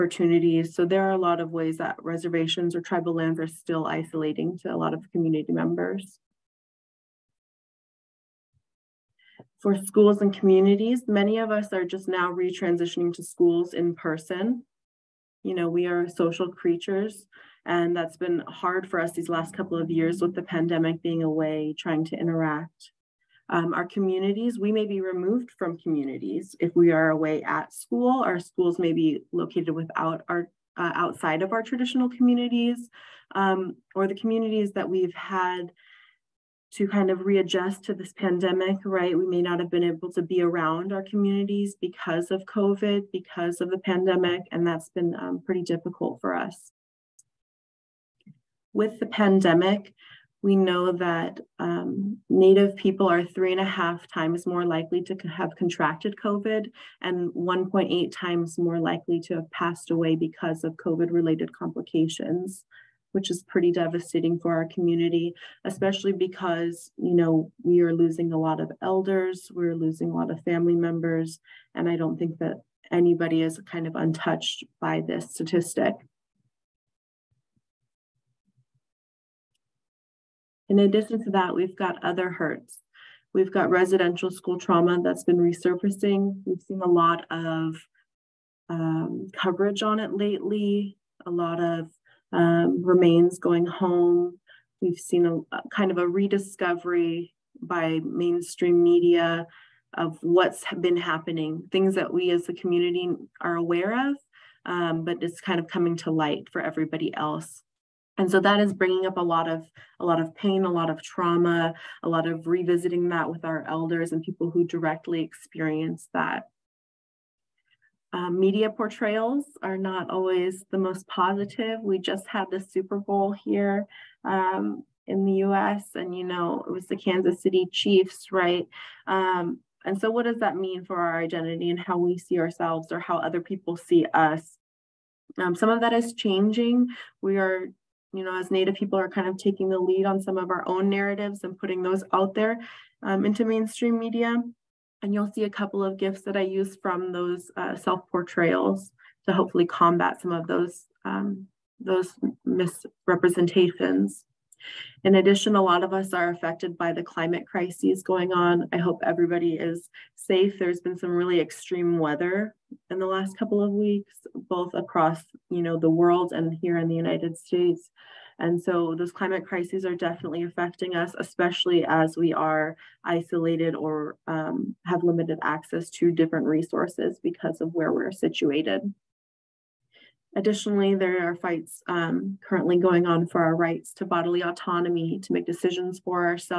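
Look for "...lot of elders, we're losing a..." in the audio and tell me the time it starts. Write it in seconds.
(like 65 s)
68 s.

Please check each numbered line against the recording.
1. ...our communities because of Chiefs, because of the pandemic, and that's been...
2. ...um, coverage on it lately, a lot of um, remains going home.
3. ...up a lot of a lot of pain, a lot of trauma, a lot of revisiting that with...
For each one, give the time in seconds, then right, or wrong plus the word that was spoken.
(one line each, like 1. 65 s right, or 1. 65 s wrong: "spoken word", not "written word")
1. 40 s wrong: "COVID", not "Chiefs"
2. 88 s right
3. 109 s right.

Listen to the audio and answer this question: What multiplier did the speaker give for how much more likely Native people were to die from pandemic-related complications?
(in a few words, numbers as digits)
1.8 times.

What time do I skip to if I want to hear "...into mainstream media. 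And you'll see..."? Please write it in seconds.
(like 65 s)
143 s.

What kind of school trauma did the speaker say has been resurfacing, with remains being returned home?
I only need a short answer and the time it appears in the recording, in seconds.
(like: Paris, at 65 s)
Residential school, at 83 s.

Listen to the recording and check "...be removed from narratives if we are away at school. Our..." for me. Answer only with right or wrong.
wrong.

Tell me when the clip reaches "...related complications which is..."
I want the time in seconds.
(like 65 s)
61 s.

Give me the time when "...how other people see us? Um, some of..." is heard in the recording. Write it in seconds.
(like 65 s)
132 s.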